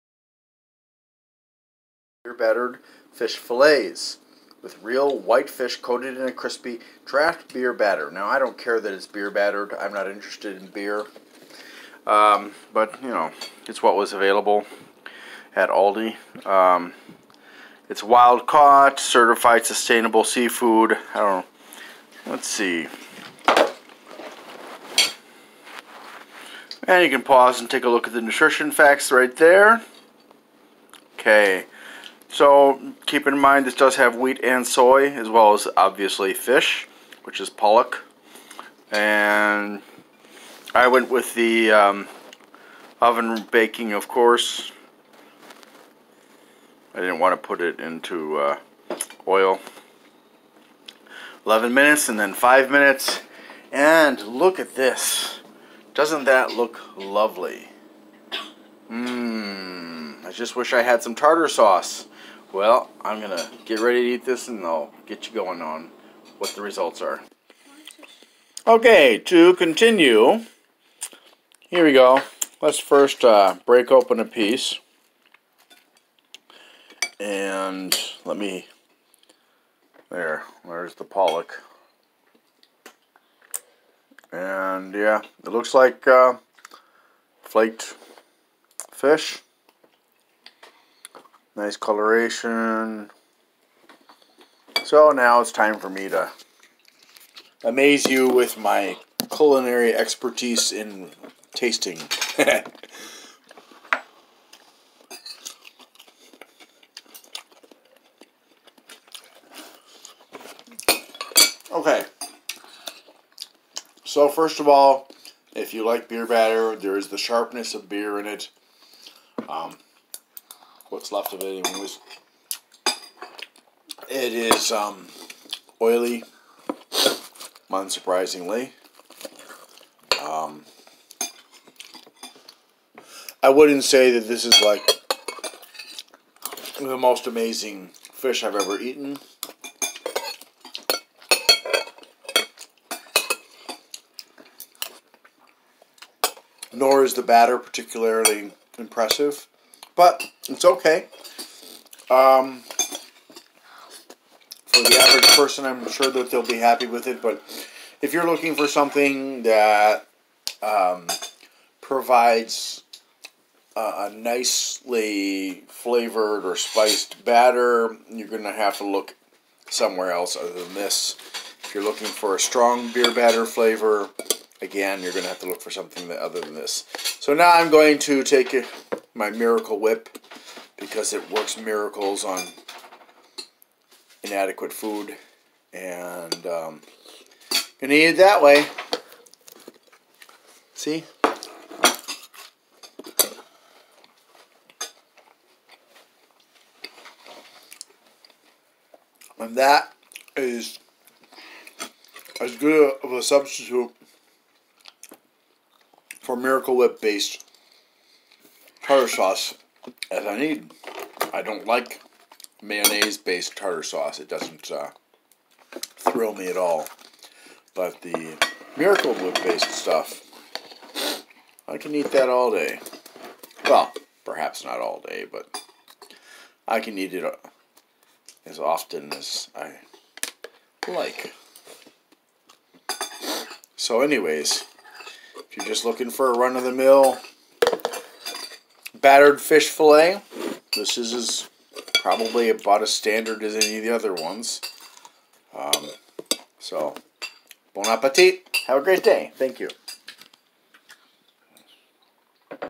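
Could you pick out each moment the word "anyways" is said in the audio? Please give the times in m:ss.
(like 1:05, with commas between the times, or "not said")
2:01, 3:54.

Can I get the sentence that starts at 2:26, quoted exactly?
Nor is the batter particularly impressive but it's okay.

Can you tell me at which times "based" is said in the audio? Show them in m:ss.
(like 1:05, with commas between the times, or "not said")
3:27, 3:33, 3:39.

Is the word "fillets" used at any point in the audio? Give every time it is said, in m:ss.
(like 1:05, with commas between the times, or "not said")
0:03, 3:59.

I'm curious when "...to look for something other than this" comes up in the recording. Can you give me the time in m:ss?
2:55.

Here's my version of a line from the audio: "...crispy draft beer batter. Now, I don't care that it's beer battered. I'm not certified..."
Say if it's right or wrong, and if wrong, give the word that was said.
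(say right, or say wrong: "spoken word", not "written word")
wrong: "interested", not "certified".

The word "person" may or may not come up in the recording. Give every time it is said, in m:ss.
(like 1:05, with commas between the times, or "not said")
2:35.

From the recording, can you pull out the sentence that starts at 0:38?
And I went with the um, oven baking, of course.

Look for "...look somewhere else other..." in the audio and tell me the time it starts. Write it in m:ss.
2:48.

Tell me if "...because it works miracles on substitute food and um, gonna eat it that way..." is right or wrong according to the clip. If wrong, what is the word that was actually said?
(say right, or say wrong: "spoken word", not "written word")
wrong: "inadequate", not "substitute".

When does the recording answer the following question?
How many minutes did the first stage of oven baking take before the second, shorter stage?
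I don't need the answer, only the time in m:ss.
0:51.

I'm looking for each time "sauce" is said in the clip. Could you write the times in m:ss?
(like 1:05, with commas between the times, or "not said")
1:01, 3:29, 3:33.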